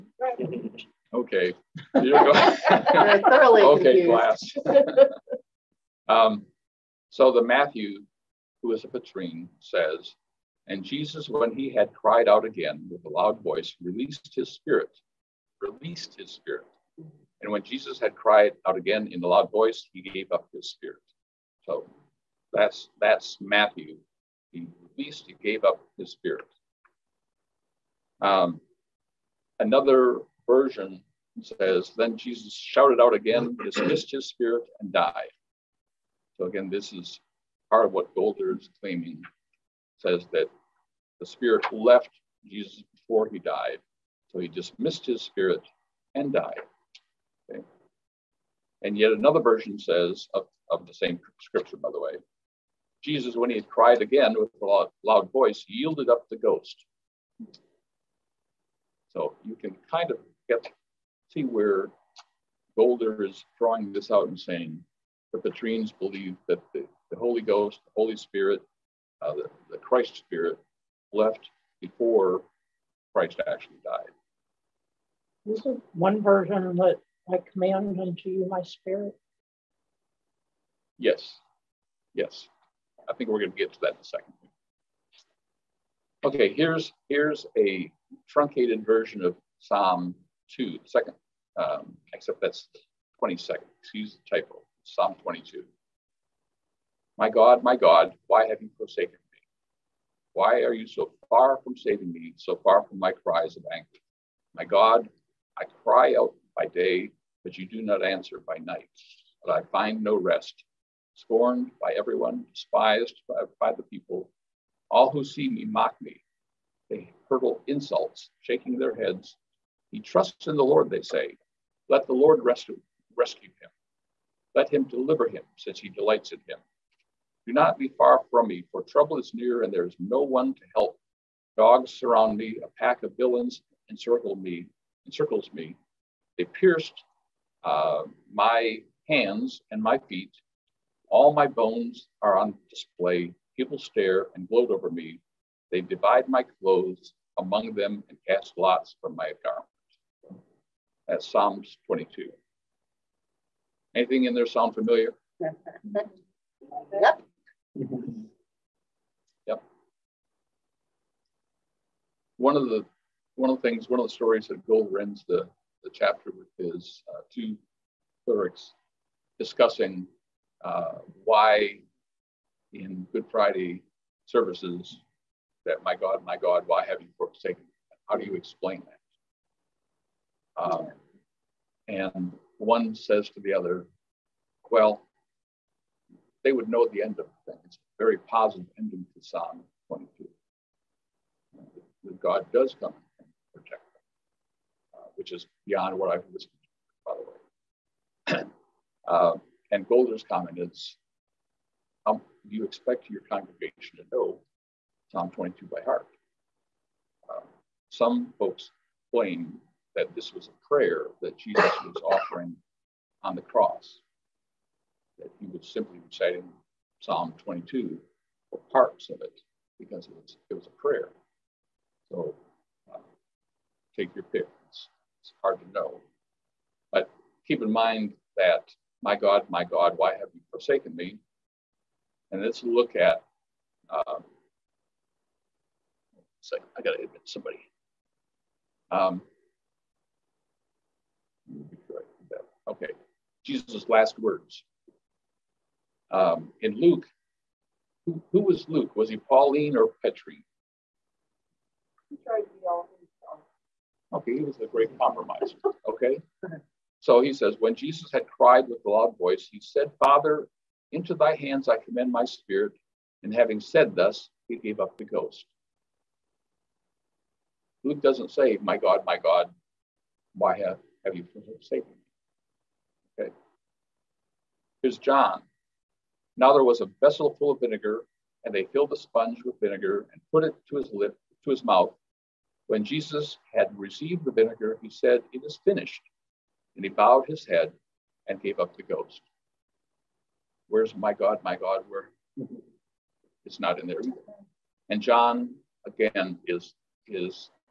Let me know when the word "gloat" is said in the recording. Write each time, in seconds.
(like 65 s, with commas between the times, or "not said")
144 s.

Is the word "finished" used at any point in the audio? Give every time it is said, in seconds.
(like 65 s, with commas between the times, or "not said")
285 s.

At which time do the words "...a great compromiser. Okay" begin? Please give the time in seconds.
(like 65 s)
254 s.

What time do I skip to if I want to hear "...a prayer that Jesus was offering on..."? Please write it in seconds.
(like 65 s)
210 s.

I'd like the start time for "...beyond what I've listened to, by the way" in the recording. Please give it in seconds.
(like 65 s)
195 s.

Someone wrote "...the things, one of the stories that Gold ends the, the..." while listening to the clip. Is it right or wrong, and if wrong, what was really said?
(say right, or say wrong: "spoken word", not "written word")
right.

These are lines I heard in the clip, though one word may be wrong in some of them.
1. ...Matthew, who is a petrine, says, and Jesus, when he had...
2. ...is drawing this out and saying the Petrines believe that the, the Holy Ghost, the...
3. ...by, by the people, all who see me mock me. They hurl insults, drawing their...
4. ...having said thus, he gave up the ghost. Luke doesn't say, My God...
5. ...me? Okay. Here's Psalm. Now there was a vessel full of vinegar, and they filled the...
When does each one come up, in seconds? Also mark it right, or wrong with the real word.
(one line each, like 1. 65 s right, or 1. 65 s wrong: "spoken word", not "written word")
1. 7 s right
2. 63 s right
3. 113 s wrong: "shaking", not "drawing"
4. 263 s right
5. 271 s wrong: "John", not "Psalm".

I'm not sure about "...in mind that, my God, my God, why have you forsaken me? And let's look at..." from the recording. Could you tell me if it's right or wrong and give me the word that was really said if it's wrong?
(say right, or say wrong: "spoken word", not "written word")
right.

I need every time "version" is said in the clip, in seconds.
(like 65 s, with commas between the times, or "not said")
30 s, 49 s, 76 s, 88 s.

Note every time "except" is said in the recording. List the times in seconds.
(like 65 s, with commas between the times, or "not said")
92 s.